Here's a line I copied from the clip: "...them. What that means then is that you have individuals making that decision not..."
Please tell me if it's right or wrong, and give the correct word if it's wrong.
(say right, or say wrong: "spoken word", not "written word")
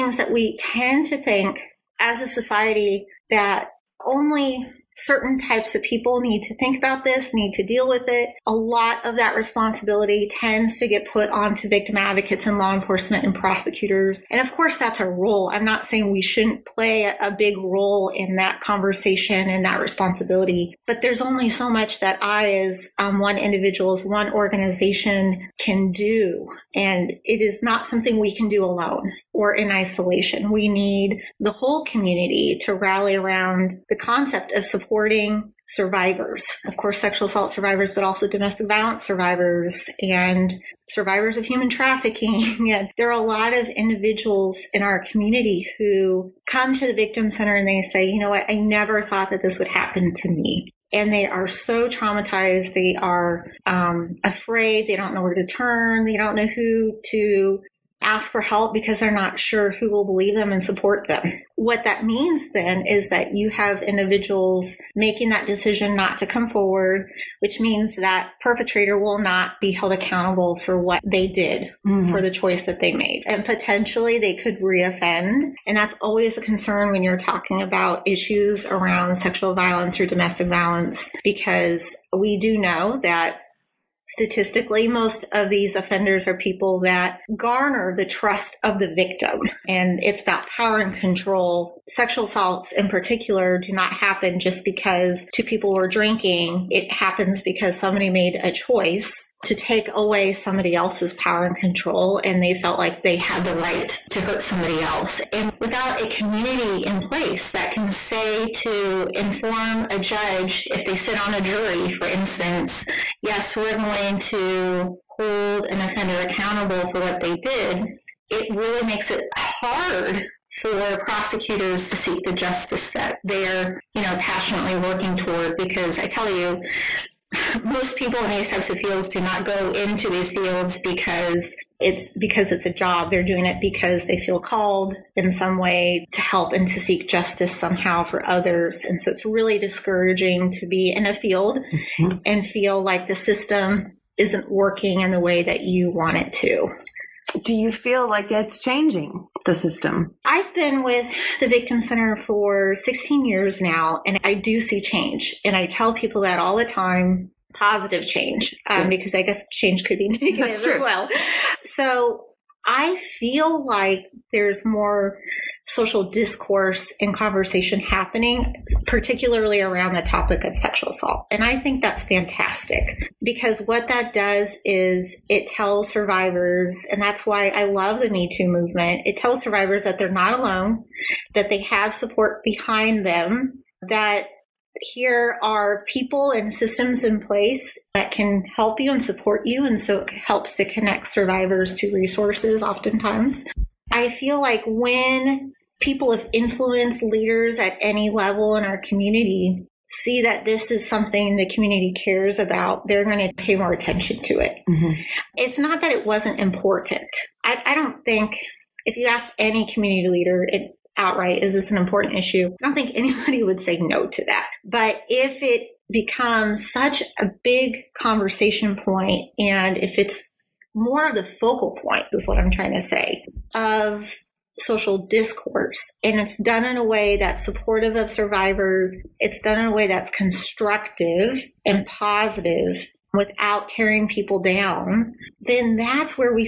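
right.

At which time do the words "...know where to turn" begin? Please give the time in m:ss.
0:55.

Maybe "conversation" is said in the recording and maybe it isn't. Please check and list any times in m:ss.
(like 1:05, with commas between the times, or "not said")
0:18, 2:47, 3:37.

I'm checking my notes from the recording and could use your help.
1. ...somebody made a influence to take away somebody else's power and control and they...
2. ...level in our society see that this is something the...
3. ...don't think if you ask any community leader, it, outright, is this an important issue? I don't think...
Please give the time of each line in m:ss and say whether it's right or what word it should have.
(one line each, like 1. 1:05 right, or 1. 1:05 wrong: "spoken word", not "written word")
1. 1:37 wrong: "choice", not "influence"
2. 3:18 wrong: "community", not "society"
3. 3:27 right.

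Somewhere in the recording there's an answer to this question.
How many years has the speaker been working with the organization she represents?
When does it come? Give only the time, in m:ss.
2:32.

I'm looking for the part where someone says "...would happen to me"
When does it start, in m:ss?
0:49.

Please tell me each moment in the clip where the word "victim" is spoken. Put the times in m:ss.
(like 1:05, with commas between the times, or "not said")
0:11, 0:46, 1:28, 2:31.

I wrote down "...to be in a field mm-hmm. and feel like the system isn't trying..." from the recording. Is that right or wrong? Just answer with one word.
wrong.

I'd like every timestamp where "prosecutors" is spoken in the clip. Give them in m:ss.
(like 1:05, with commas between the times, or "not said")
0:13, 2:01.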